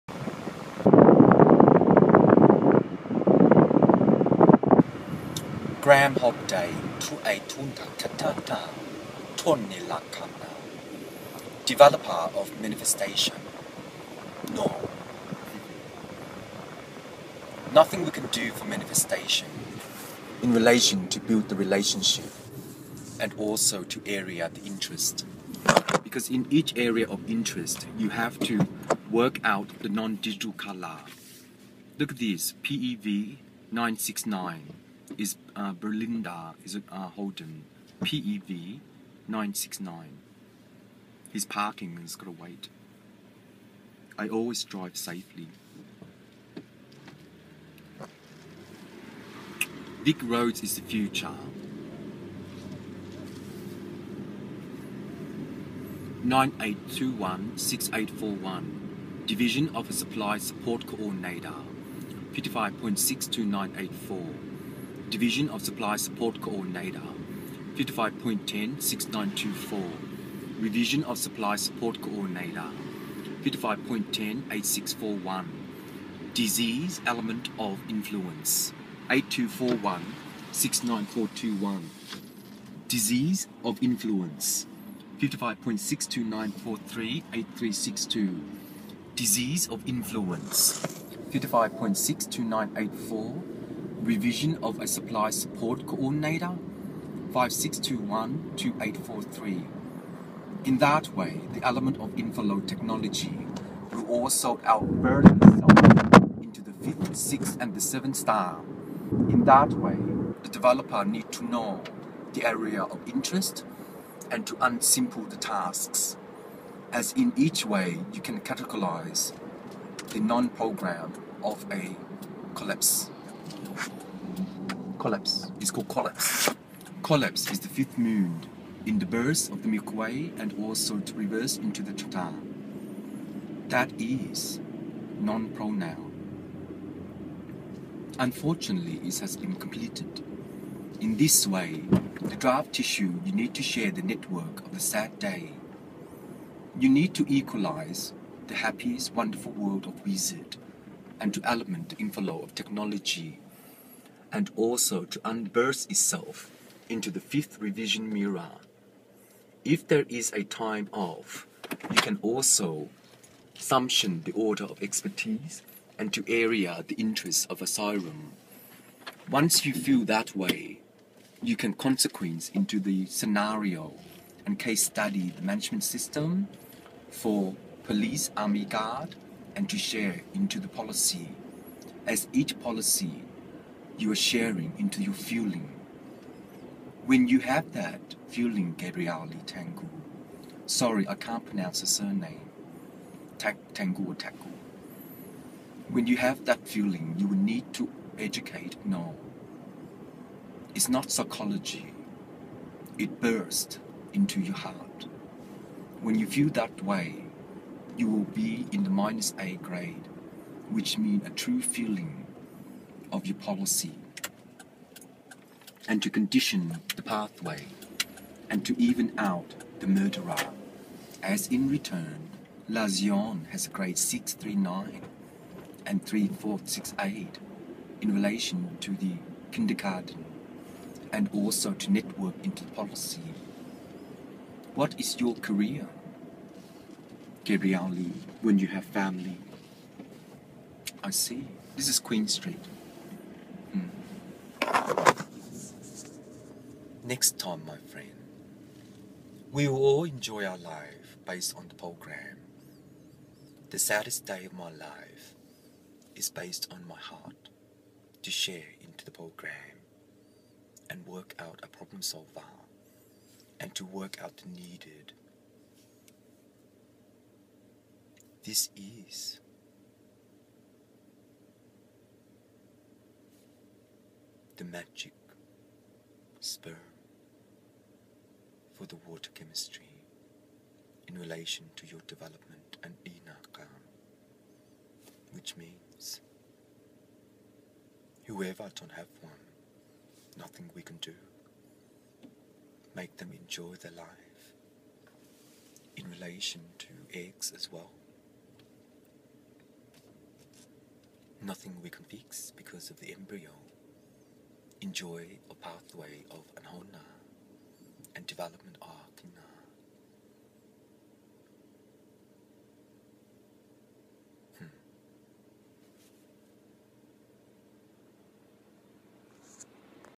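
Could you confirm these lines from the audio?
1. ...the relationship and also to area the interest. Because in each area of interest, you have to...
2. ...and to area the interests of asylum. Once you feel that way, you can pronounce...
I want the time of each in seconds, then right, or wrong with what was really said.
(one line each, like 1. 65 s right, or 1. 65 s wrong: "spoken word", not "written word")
1. 21 s right
2. 165 s wrong: "consequence", not "pronounce".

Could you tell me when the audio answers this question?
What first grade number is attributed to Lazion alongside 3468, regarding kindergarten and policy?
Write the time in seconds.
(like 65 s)
223 s.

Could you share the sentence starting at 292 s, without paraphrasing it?
Make them enjoy their life in relation to eggs as well.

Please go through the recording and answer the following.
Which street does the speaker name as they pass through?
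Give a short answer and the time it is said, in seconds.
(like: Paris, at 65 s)
Queen Street, at 241 s.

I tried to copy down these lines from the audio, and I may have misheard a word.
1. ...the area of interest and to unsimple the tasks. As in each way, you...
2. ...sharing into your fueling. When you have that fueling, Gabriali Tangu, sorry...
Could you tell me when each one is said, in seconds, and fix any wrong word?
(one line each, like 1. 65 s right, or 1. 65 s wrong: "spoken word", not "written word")
1. 112 s right
2. 184 s right.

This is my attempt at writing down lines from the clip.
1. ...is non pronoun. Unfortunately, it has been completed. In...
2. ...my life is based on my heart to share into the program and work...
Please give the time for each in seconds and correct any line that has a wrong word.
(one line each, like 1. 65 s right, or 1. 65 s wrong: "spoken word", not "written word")
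1. 133 s right
2. 254 s right.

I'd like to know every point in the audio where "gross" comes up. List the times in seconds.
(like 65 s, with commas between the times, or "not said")
not said.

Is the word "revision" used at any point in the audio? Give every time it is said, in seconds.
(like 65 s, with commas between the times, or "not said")
70 s, 94 s, 157 s.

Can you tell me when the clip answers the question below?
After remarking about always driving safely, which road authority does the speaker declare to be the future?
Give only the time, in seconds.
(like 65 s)
50 s.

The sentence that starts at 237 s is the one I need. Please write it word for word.
Gabrielle Lee, when you have family.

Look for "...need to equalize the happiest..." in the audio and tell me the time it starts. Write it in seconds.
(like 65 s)
146 s.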